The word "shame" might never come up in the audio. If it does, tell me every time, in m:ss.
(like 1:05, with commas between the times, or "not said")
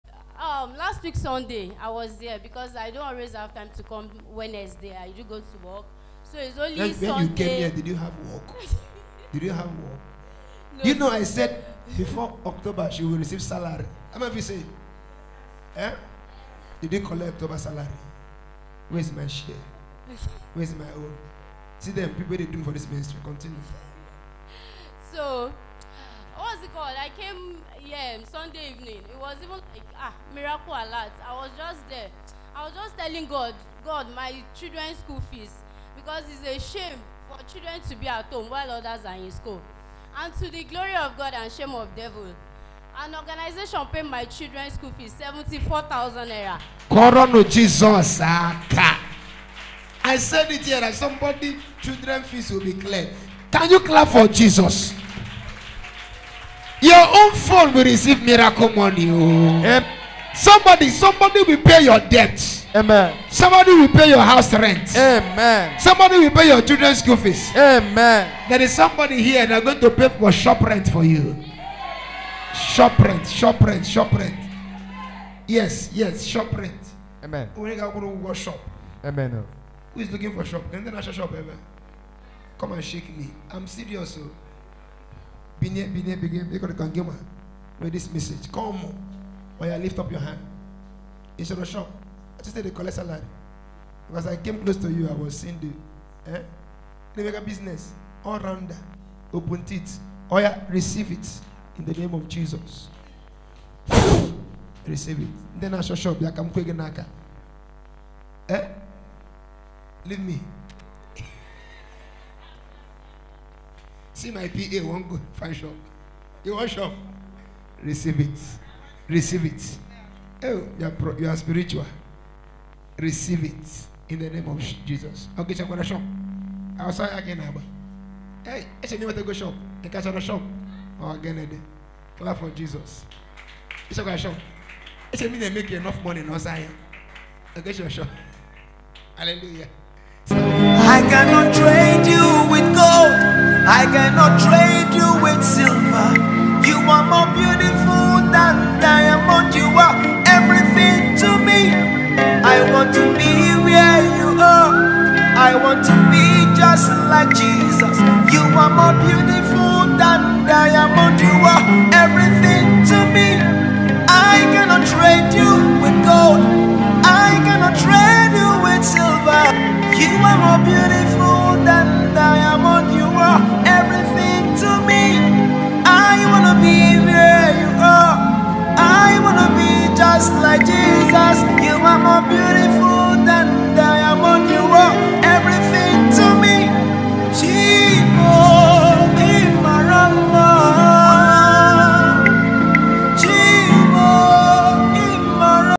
0:36, 0:41.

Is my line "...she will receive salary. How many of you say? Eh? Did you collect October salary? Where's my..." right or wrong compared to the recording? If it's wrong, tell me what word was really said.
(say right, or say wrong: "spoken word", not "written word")
right.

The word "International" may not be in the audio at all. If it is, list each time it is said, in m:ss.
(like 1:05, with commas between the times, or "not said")
1:20.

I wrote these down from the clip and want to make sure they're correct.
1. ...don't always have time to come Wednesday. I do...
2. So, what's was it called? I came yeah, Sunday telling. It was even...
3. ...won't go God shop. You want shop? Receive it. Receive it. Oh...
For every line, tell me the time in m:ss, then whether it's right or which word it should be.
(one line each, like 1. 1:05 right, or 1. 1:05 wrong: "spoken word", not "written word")
1. 0:02 right
2. 0:25 wrong: "evening", not "telling"
3. 1:54 wrong: "Fine", not "God".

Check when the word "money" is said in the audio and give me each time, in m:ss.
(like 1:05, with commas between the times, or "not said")
0:58, 2:16.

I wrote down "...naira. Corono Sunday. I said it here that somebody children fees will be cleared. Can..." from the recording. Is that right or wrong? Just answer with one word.
wrong.